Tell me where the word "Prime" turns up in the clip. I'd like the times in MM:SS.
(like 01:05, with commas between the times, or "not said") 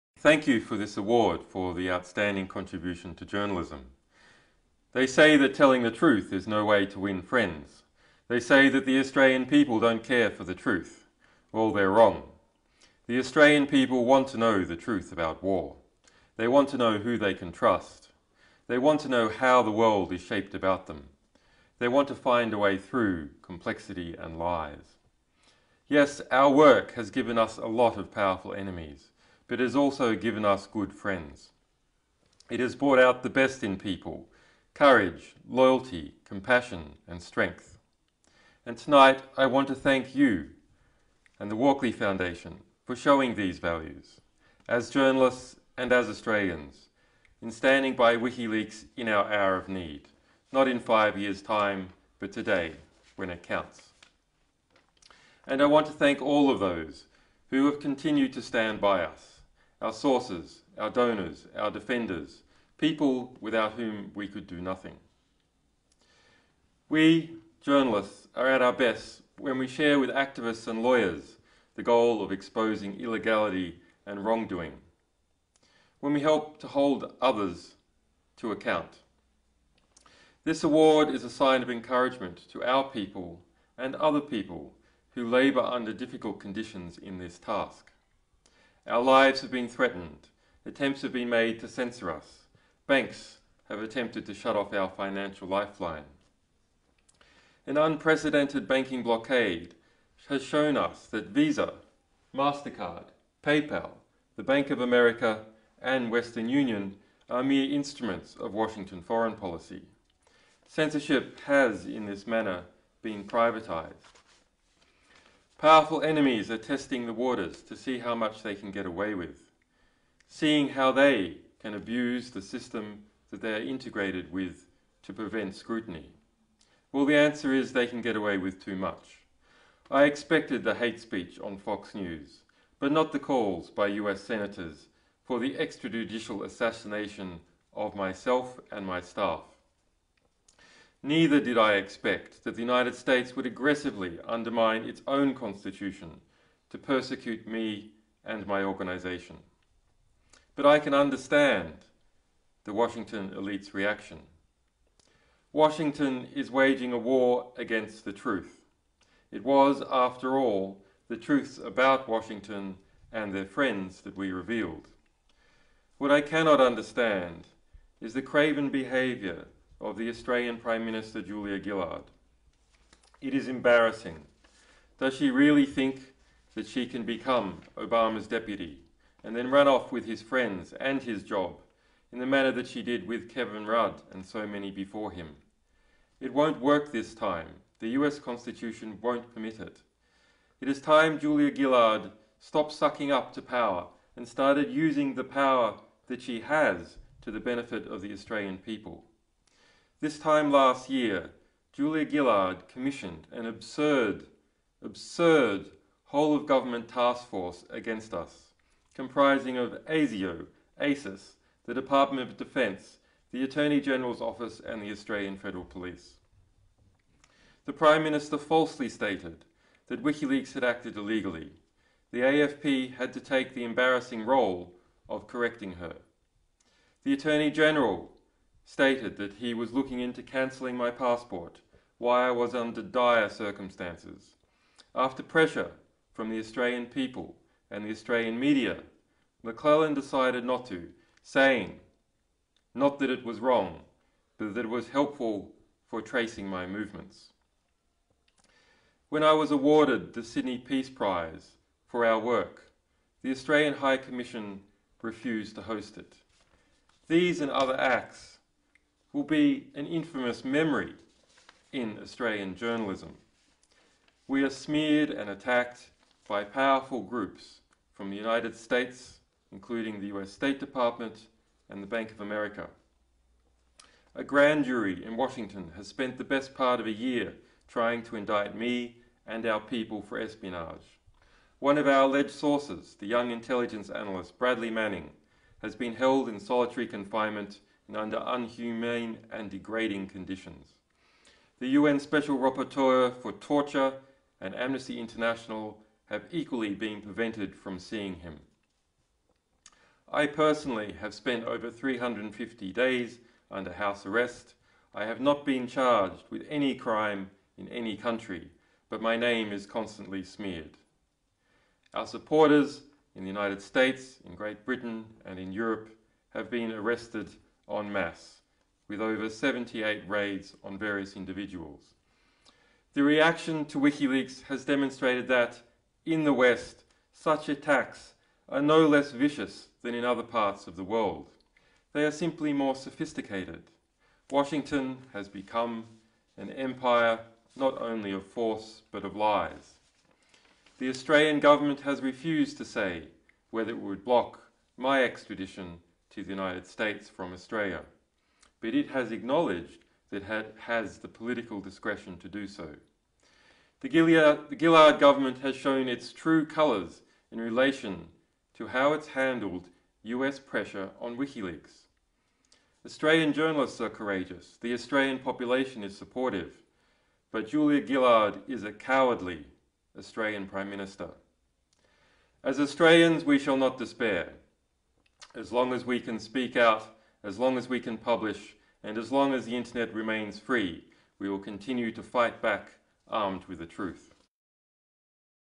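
02:50, 03:37, 06:10.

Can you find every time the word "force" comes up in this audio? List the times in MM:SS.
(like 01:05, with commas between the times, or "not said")
03:27, 05:38.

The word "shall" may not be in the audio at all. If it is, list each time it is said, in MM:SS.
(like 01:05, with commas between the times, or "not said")
06:13.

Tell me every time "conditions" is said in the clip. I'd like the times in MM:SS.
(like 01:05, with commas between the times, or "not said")
01:26, 04:50.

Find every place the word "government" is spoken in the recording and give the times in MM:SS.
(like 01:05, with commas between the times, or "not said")
03:26, 05:41, 05:54.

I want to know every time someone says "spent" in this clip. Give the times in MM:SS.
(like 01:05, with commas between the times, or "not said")
04:35, 05:01.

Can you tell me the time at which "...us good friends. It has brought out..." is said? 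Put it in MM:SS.
00:30.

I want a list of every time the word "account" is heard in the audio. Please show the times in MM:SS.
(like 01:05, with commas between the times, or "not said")
01:18.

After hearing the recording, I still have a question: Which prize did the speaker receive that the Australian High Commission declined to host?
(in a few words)
Sydney Peace Prize.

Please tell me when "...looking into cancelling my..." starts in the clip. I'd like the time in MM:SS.
03:49.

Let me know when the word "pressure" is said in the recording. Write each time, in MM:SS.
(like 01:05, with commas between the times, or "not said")
03:55, 06:00.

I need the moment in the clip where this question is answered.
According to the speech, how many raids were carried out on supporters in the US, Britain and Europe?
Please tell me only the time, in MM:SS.
05:19.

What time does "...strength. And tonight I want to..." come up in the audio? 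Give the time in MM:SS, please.
00:37.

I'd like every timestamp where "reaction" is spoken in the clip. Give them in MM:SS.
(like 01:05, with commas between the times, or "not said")
02:33, 05:23.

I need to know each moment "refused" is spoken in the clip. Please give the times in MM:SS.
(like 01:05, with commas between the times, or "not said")
04:15, 05:42.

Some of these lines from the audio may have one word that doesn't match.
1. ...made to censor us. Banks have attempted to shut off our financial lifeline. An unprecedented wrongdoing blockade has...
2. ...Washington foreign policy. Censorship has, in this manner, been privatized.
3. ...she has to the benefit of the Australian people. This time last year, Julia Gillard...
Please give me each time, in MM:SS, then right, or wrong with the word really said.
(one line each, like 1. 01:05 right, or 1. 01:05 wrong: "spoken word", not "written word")
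1. 01:31 wrong: "banking", not "wrongdoing"
2. 01:48 right
3. 03:16 right.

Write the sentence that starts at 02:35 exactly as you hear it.
Washington is waging a war against the truth.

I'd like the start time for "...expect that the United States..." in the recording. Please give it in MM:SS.
02:21.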